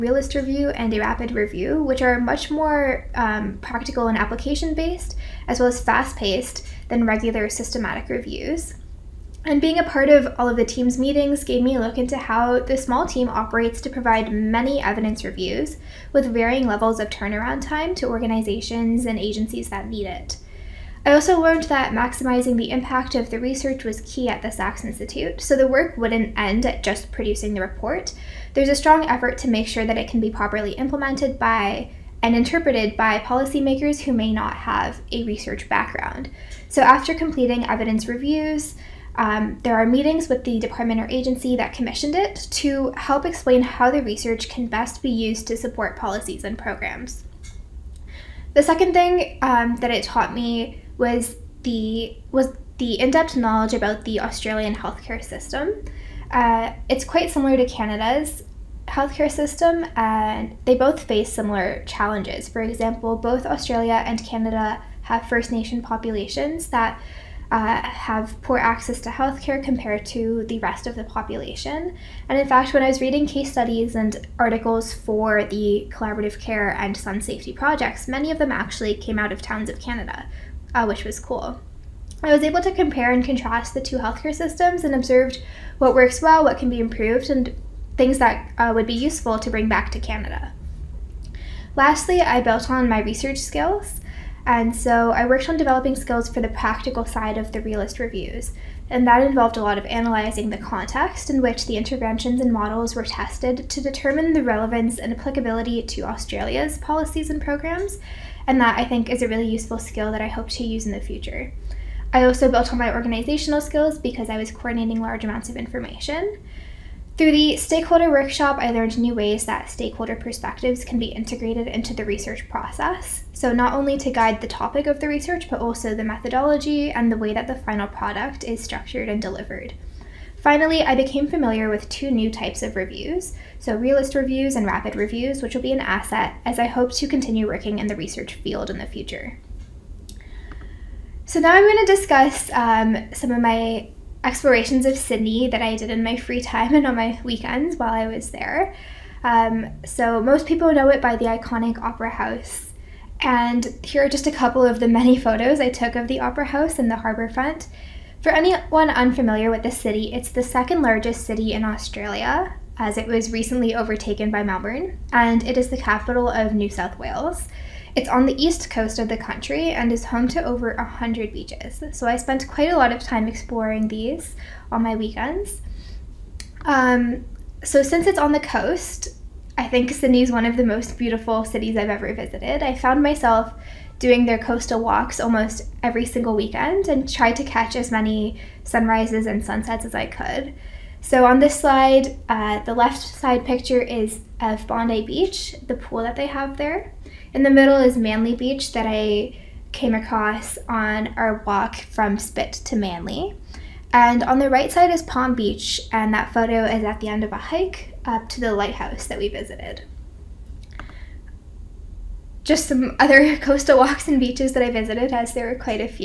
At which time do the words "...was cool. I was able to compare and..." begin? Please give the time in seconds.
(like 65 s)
81 s.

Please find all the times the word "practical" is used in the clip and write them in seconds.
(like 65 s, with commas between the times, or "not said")
3 s, 96 s.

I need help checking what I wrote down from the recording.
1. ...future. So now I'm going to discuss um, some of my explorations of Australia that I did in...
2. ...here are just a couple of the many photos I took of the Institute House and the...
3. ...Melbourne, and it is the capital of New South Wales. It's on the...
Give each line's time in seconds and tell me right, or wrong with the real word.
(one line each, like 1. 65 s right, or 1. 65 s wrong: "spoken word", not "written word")
1. 138 s wrong: "Sydney", not "Australia"
2. 153 s wrong: "Opera", not "Institute"
3. 164 s right.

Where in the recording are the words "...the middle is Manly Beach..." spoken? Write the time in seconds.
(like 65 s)
197 s.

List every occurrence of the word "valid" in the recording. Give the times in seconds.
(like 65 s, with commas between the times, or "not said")
not said.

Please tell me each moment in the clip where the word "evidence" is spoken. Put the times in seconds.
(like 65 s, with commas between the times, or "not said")
14 s, 37 s.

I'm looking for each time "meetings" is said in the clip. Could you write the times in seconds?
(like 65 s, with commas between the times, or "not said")
10 s, 39 s.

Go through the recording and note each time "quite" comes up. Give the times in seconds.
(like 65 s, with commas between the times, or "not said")
57 s, 172 s.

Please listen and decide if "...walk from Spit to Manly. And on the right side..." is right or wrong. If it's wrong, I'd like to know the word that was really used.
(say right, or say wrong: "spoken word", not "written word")
right.